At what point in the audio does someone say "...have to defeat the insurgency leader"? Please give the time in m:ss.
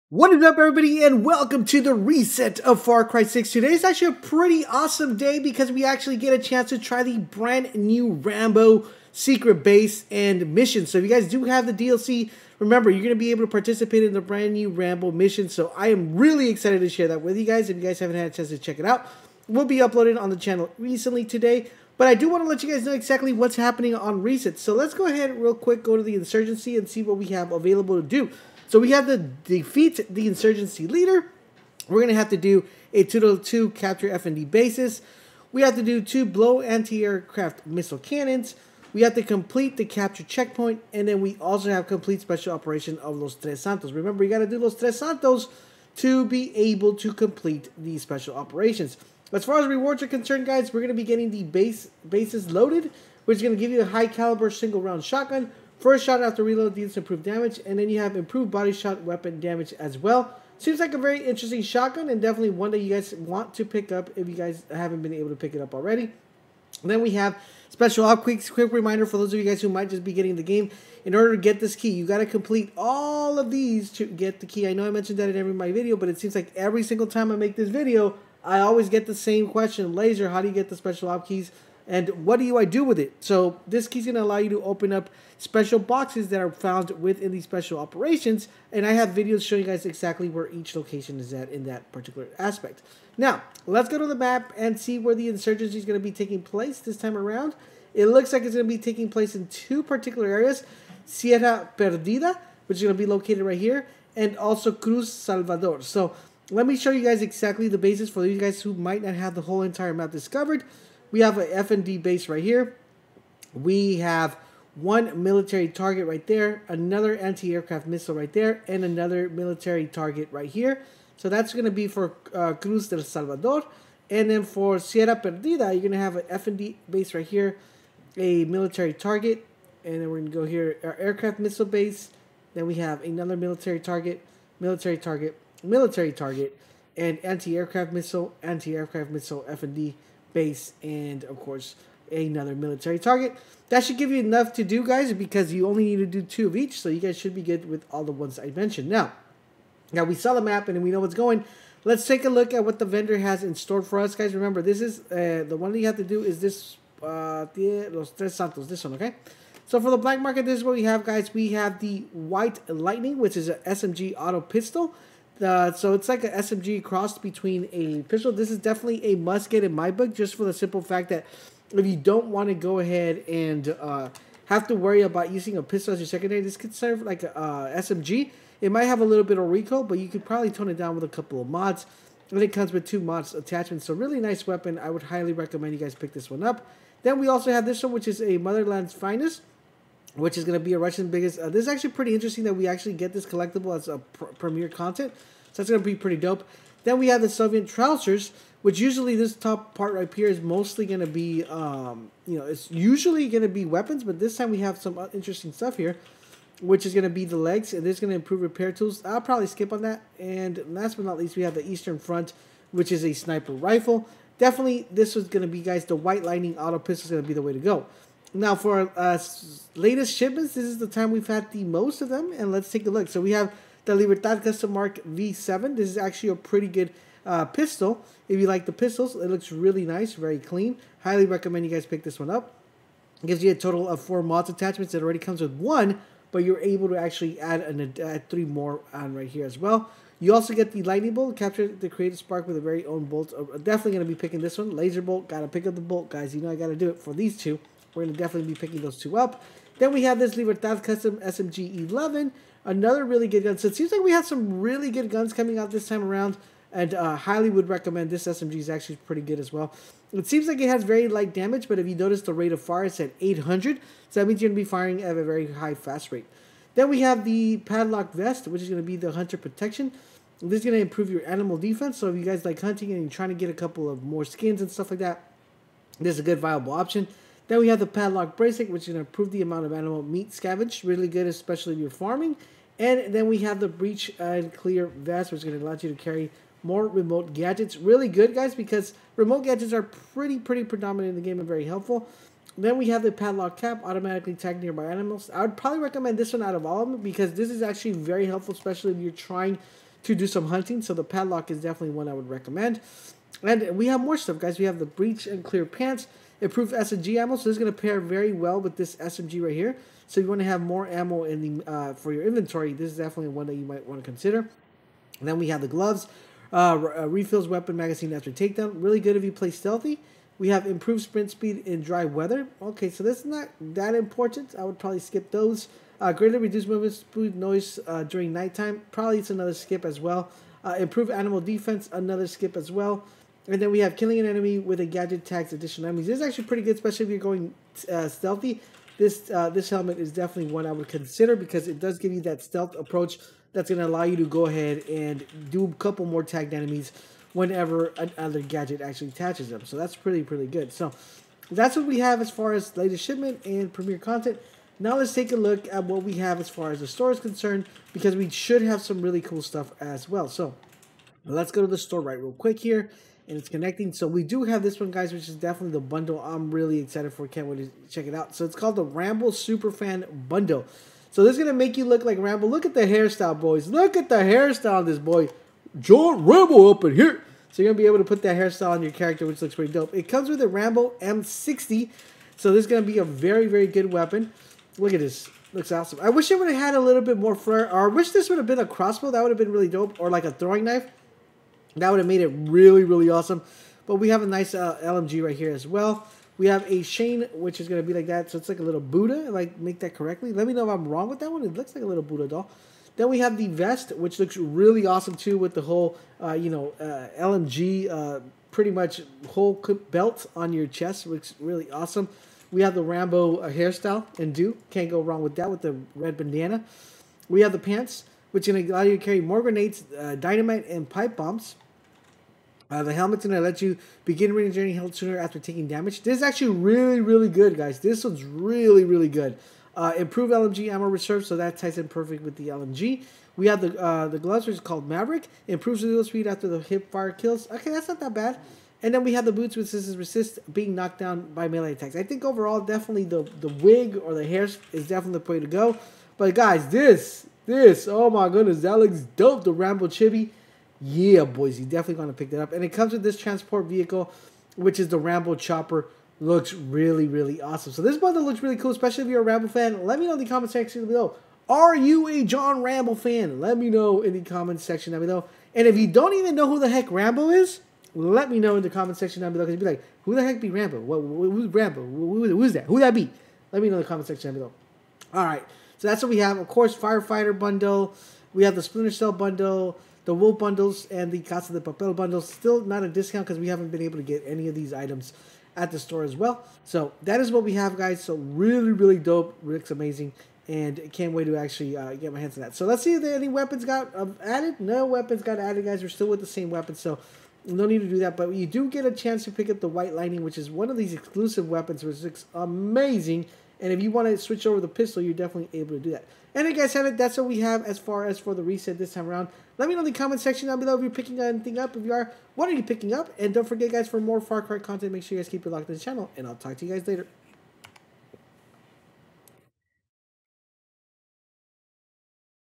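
0:28.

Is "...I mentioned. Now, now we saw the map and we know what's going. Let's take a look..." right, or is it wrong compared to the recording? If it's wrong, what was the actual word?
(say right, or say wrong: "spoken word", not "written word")
right.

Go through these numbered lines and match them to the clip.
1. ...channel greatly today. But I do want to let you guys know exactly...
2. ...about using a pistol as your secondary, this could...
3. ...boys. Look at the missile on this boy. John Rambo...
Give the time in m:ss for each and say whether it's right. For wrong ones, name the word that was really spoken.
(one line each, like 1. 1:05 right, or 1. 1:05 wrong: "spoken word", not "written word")
1. 0:20 wrong: "recently", not "greatly"
2. 2:55 right
3. 6:13 wrong: "hairstyle", not "missile".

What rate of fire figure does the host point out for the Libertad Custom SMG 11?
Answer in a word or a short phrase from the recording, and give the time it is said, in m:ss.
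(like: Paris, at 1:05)
800, at 4:23.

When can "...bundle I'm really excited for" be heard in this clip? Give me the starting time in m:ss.
6:05.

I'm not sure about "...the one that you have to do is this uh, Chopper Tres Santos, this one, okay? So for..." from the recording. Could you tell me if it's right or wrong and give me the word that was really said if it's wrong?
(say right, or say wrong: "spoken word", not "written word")
wrong: "Los", not "Chopper".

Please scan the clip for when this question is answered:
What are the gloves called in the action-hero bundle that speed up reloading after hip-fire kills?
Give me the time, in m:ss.
7:14.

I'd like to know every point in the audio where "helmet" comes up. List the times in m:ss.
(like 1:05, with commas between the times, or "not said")
5:39, 7:02.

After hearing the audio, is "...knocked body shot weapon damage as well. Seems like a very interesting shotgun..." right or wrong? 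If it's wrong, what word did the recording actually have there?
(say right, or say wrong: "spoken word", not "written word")
wrong: "improved", not "knocked".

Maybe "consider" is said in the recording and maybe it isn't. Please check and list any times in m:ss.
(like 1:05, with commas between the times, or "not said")
5:14, 5:40.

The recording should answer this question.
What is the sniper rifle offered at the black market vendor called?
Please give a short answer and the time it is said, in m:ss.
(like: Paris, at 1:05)
Eastern Front, at 3:31.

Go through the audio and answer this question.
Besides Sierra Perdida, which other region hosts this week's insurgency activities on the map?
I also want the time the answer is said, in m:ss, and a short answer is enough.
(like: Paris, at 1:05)
Cruz Salvador, at 1:44.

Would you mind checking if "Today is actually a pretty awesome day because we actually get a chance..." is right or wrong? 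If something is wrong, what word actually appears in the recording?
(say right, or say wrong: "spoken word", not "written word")
right.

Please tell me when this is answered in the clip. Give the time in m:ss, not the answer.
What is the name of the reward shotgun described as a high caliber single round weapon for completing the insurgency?
0:52.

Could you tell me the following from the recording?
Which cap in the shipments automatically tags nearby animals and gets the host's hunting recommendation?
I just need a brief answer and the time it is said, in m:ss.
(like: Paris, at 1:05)
padlock cap, at 4:53.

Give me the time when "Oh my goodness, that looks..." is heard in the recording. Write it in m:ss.
7:27.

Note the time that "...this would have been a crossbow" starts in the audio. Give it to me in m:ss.
6:28.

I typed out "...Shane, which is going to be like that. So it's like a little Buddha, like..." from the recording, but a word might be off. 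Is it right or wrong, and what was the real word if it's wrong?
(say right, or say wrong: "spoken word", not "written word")
right.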